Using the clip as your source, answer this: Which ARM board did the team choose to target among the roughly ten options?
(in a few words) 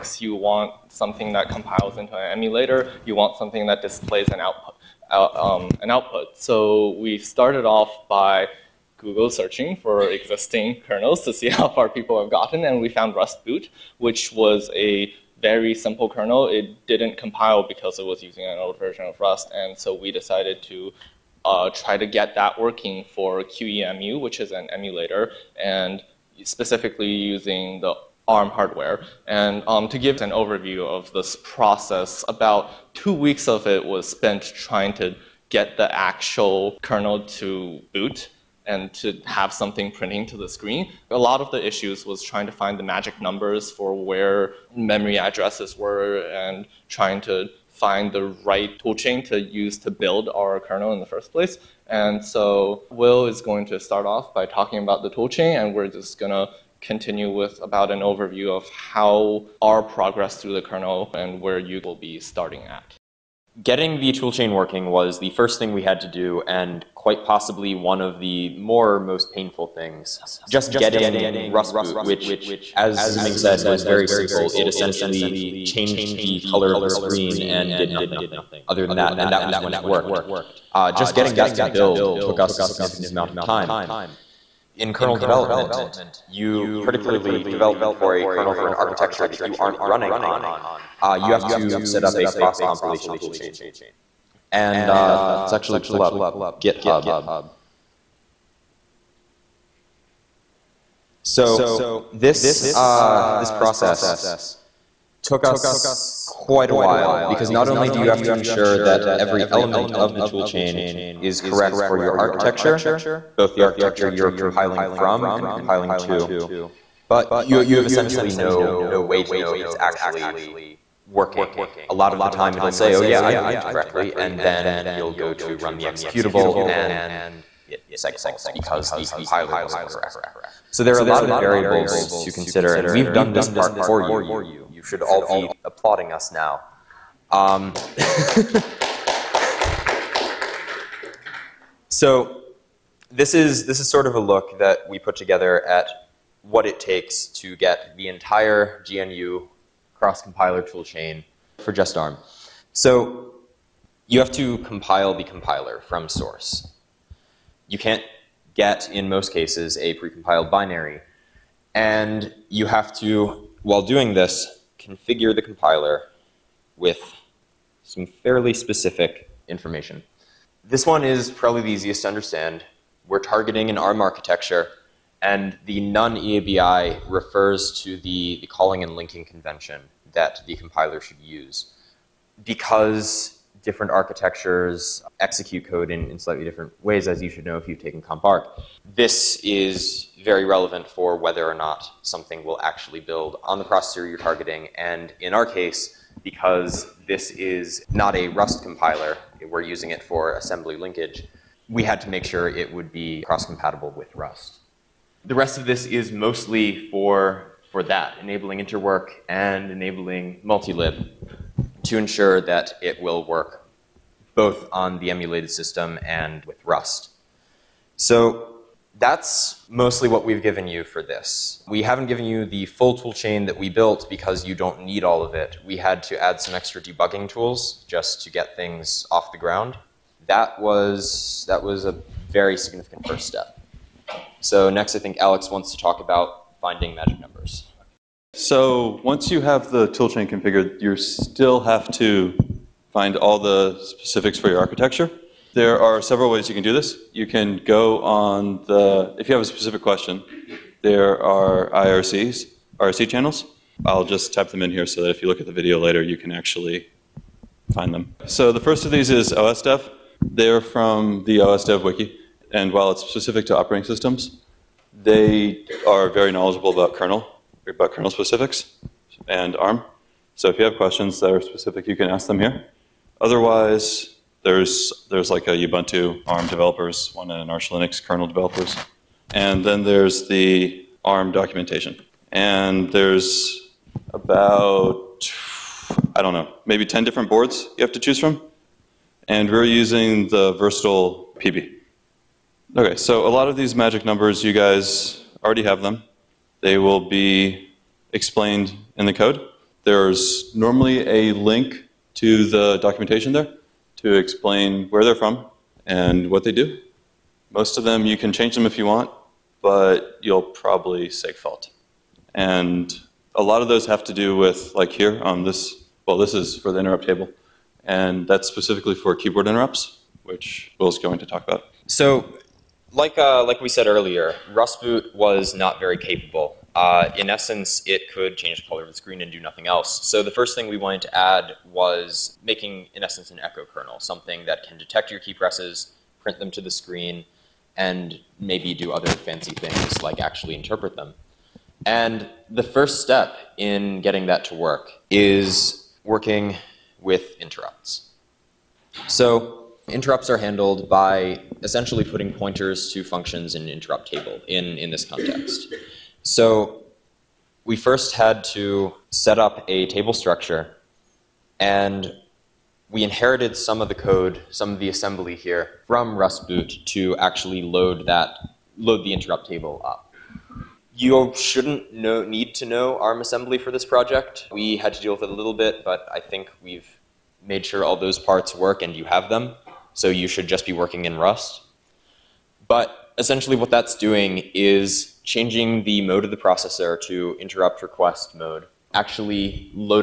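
Versatile PB.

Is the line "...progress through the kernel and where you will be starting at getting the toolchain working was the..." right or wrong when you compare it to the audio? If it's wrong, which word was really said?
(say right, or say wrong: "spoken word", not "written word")
right.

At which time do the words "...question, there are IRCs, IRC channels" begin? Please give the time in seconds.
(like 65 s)
249 s.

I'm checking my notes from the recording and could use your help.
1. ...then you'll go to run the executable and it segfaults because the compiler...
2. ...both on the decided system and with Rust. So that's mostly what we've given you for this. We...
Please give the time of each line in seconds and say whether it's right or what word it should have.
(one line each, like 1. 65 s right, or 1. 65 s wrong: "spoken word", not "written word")
1. 124 s right
2. 214 s wrong: "emulated", not "decided".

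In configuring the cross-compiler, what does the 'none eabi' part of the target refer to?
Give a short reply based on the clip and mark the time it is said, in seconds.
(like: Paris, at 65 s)
calling and linking convention, at 178 s.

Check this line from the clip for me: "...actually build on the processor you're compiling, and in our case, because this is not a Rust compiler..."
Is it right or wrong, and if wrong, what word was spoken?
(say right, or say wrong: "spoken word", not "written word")
wrong: "targeting", not "compiling".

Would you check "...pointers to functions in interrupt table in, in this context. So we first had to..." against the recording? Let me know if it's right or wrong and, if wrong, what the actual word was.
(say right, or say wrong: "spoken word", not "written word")
right.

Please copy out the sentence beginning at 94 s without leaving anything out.
And uh, let's actually pull up GitHub.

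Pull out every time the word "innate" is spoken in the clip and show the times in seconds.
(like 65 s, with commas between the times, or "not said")
not said.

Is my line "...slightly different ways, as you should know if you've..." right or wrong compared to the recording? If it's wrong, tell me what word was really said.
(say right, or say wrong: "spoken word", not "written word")
right.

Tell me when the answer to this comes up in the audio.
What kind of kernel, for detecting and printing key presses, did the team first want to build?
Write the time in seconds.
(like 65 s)
333 s.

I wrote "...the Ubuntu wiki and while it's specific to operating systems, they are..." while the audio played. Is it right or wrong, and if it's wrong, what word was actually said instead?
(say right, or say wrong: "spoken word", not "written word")
wrong: "OSDev", not "Ubuntu".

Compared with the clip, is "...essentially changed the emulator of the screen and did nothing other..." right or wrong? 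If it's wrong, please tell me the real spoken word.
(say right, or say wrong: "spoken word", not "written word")
wrong: "color", not "emulator".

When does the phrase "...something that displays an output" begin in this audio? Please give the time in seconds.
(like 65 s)
3 s.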